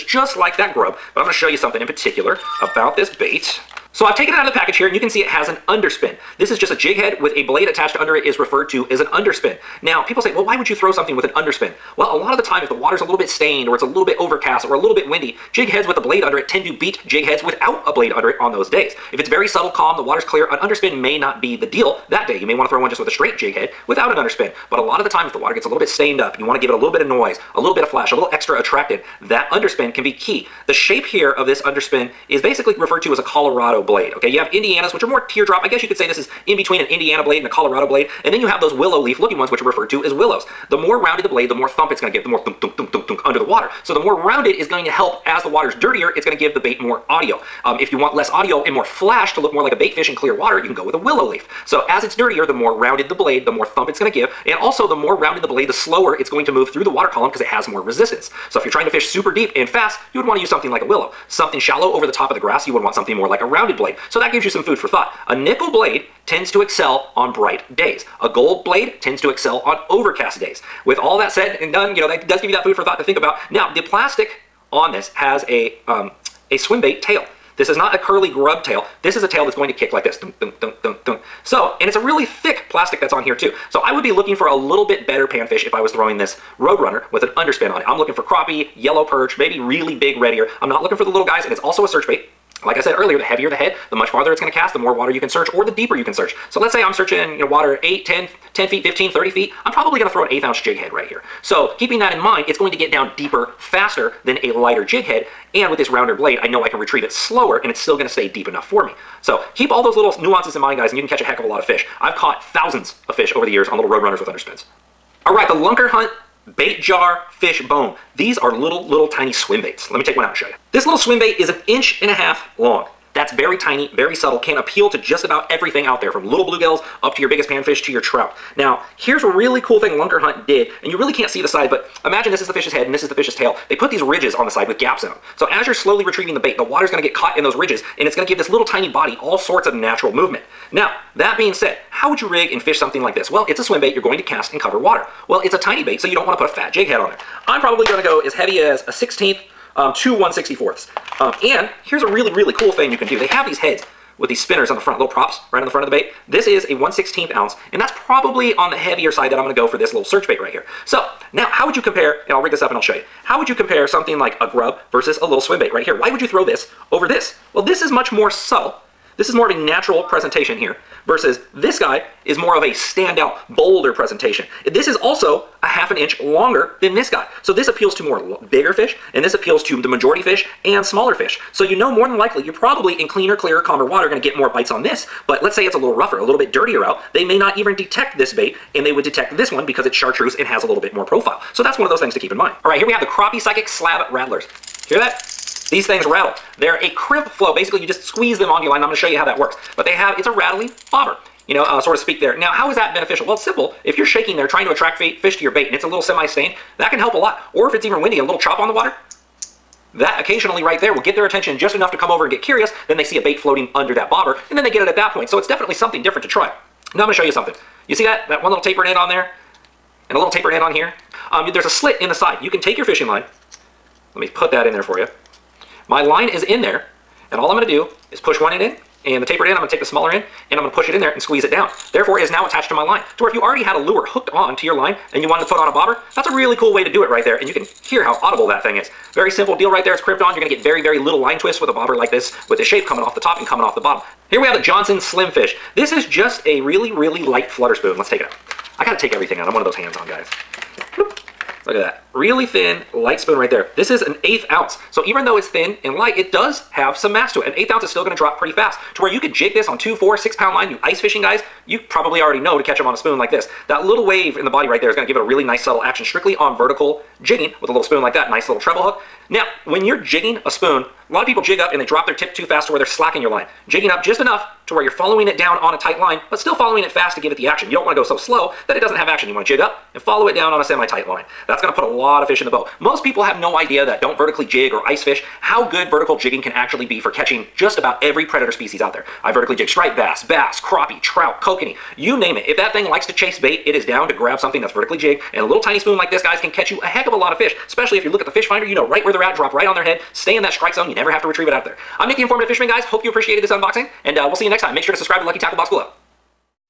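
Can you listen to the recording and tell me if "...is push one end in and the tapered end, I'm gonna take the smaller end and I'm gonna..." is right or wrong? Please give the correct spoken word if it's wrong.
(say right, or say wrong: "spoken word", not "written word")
right.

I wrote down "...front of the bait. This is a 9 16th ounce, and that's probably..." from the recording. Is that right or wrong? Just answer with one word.
wrong.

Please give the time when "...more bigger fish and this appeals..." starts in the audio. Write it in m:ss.
2:58.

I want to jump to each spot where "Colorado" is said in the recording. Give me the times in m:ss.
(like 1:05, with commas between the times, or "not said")
0:33, 0:37.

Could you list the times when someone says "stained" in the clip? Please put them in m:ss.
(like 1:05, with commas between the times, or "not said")
0:13, 0:25, 3:26.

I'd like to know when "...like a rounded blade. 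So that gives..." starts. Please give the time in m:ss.
1:03.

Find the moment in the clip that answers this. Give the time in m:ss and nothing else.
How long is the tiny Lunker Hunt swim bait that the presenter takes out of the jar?
2:01.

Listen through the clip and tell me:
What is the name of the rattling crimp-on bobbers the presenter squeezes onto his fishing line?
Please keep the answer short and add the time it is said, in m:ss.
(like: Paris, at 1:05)
Crappie Psychic Slab Rattlers, at 3:13.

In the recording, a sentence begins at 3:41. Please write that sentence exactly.
Um, there's a slit in the side.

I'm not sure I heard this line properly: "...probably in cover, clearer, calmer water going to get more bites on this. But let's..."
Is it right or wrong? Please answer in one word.
wrong.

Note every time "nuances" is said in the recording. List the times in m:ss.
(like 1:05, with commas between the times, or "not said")
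1:50.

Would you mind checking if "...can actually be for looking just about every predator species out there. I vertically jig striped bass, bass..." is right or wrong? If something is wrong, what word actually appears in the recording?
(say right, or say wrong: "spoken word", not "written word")
wrong: "catching", not "looking".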